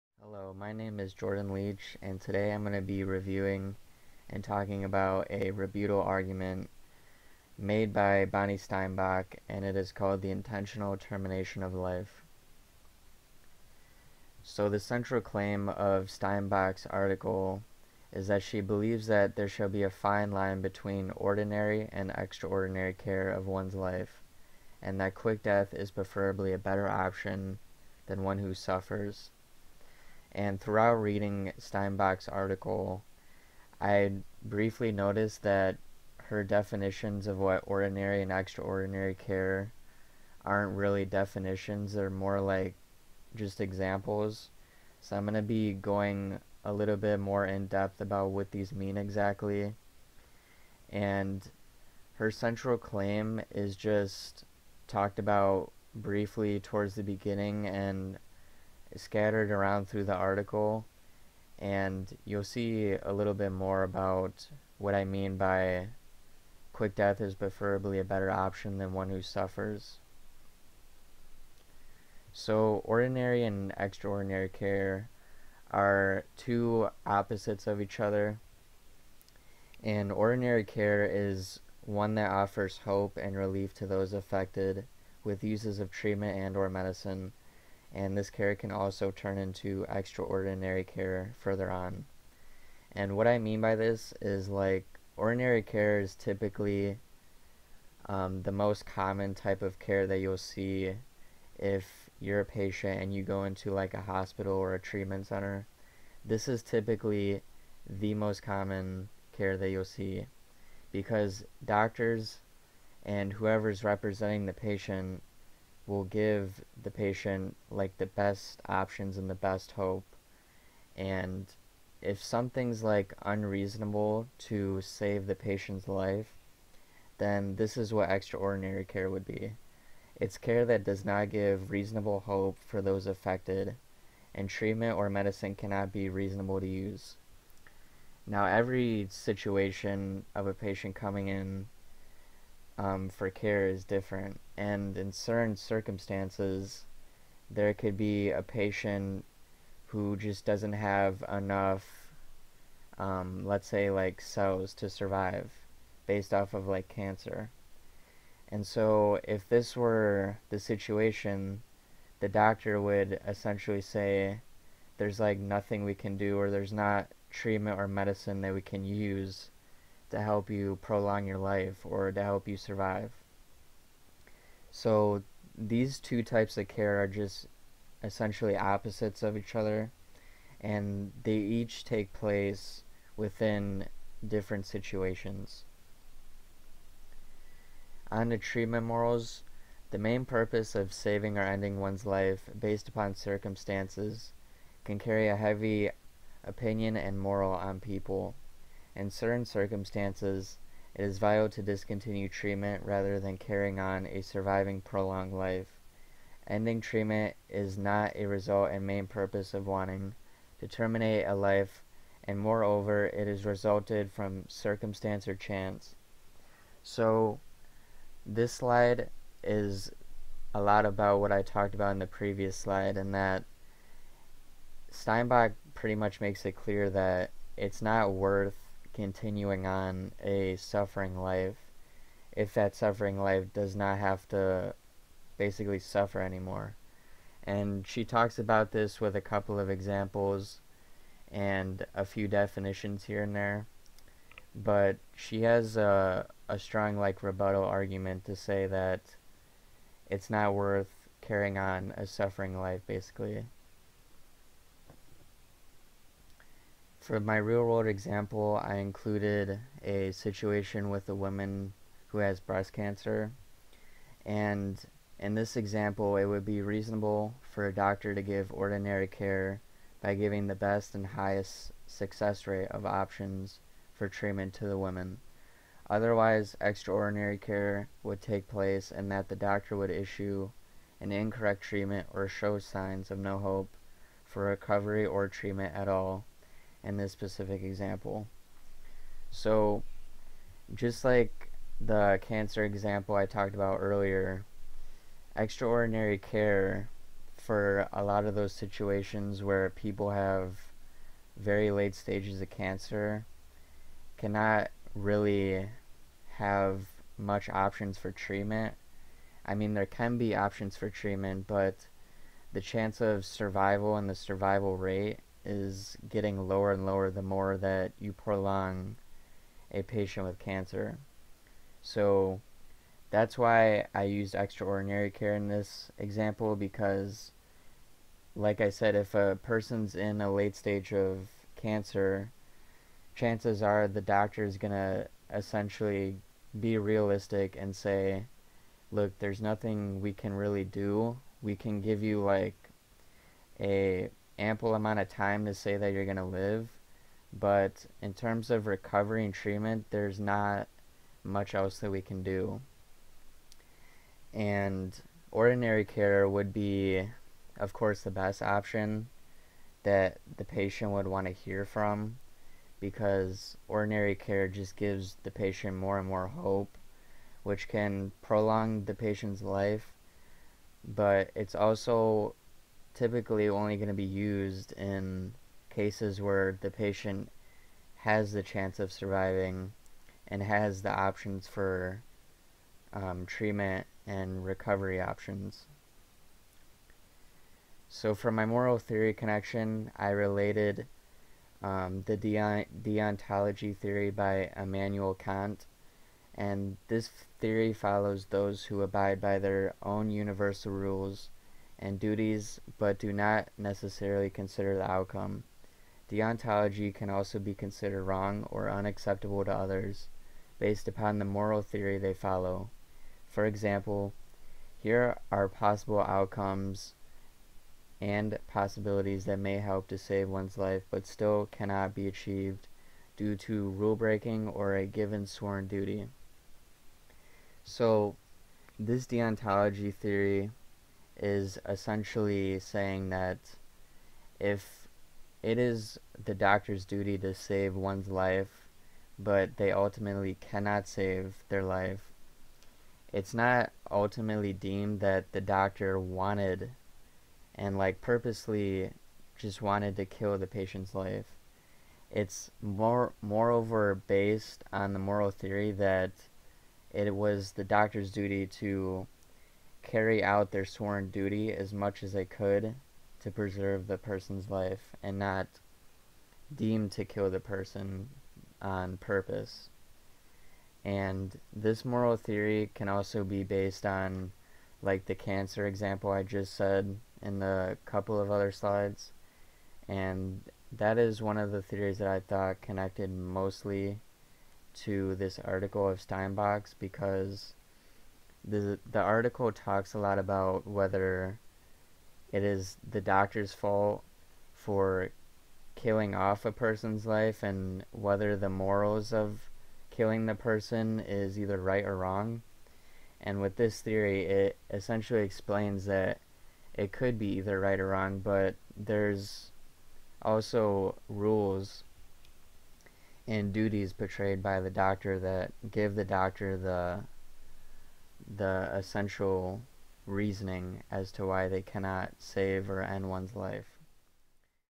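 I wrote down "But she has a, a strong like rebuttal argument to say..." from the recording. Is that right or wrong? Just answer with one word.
right.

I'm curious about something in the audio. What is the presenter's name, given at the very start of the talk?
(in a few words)
Jordan Leach.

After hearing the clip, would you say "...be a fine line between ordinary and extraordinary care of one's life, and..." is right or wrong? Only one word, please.
right.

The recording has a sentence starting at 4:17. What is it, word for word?
For my real world example, I included a situation with a woman who has breast cancer.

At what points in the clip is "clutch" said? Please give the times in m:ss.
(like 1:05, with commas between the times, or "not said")
not said.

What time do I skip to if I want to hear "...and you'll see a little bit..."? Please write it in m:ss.
1:01.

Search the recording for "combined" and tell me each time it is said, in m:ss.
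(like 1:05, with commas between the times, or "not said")
not said.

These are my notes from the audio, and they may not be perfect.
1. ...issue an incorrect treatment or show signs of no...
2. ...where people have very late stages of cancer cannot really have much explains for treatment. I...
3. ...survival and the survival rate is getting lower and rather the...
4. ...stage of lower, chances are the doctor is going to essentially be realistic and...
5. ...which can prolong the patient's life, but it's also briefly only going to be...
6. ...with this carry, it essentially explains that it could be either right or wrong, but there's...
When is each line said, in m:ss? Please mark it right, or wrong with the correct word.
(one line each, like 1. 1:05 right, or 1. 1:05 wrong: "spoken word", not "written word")
1. 4:39 right
2. 4:59 wrong: "options", not "explains"
3. 5:13 wrong: "lower", not "rather"
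4. 5:30 wrong: "cancer", not "lower"
5. 6:07 wrong: "typically", not "briefly"
6. 8:23 wrong: "theory", not "carry".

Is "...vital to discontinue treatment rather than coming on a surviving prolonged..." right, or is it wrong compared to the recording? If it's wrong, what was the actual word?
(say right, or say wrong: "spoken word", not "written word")
wrong: "carrying", not "coming".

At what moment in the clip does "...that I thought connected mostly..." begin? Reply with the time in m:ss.
8:01.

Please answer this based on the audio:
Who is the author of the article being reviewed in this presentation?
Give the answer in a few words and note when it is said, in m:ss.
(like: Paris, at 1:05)
Bonnie Steinbock, at 0:08.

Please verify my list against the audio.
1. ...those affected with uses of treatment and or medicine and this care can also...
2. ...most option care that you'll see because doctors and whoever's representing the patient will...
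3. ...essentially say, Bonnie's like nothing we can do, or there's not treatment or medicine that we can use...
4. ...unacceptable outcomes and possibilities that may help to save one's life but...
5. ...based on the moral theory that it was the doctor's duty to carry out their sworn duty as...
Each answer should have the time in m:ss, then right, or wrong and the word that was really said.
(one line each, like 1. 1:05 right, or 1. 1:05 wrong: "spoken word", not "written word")
1. 1:23 right
2. 1:48 wrong: "common", not "option"
3. 2:43 wrong: "There", not "Bonnie"
4. 6:55 wrong: "possible", not "unacceptable"
5. 7:34 right.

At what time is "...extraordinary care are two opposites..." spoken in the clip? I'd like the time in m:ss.
1:13.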